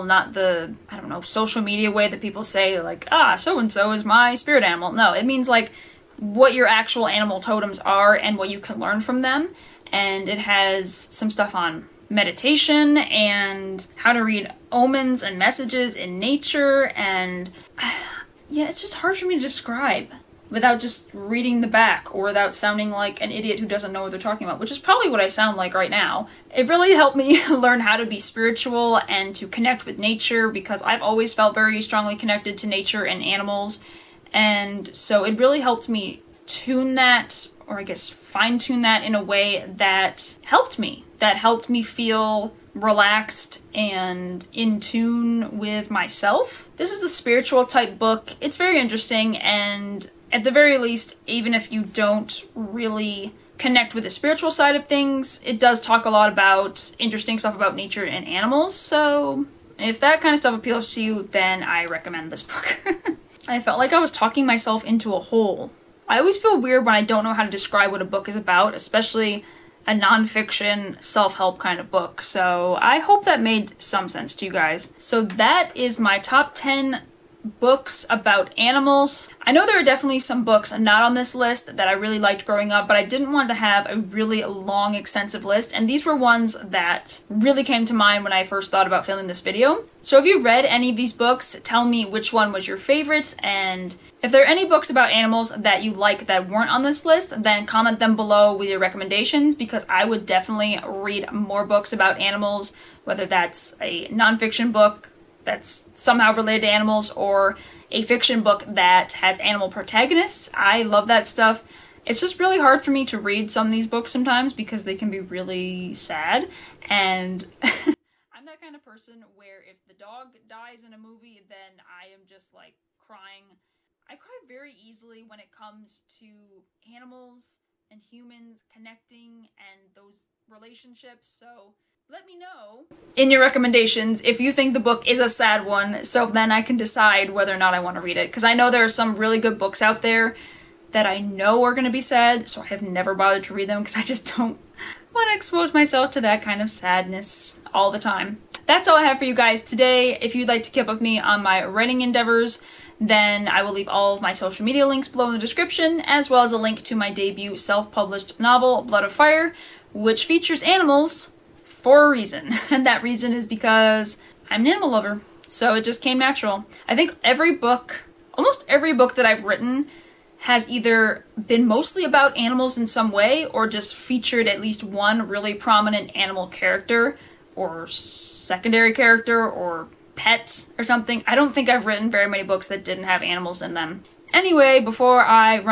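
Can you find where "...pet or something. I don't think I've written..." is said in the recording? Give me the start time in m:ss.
3:00.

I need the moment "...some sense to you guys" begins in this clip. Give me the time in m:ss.
1:13.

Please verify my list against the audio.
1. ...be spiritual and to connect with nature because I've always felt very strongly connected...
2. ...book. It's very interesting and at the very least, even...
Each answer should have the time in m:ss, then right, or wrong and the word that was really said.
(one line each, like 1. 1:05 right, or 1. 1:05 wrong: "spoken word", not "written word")
1. 0:28 right
2. 0:47 right.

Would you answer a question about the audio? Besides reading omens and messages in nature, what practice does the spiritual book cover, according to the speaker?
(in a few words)
meditation.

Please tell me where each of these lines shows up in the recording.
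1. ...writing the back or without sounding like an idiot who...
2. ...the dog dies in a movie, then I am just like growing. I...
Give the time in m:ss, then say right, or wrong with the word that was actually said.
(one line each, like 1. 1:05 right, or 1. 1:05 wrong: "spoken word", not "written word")
1. 0:21 wrong: "reading", not "writing"
2. 1:59 wrong: "crying", not "growing".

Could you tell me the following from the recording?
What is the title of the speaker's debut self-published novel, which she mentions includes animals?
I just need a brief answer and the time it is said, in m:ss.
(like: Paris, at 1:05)
Blood of Fire, at 2:38.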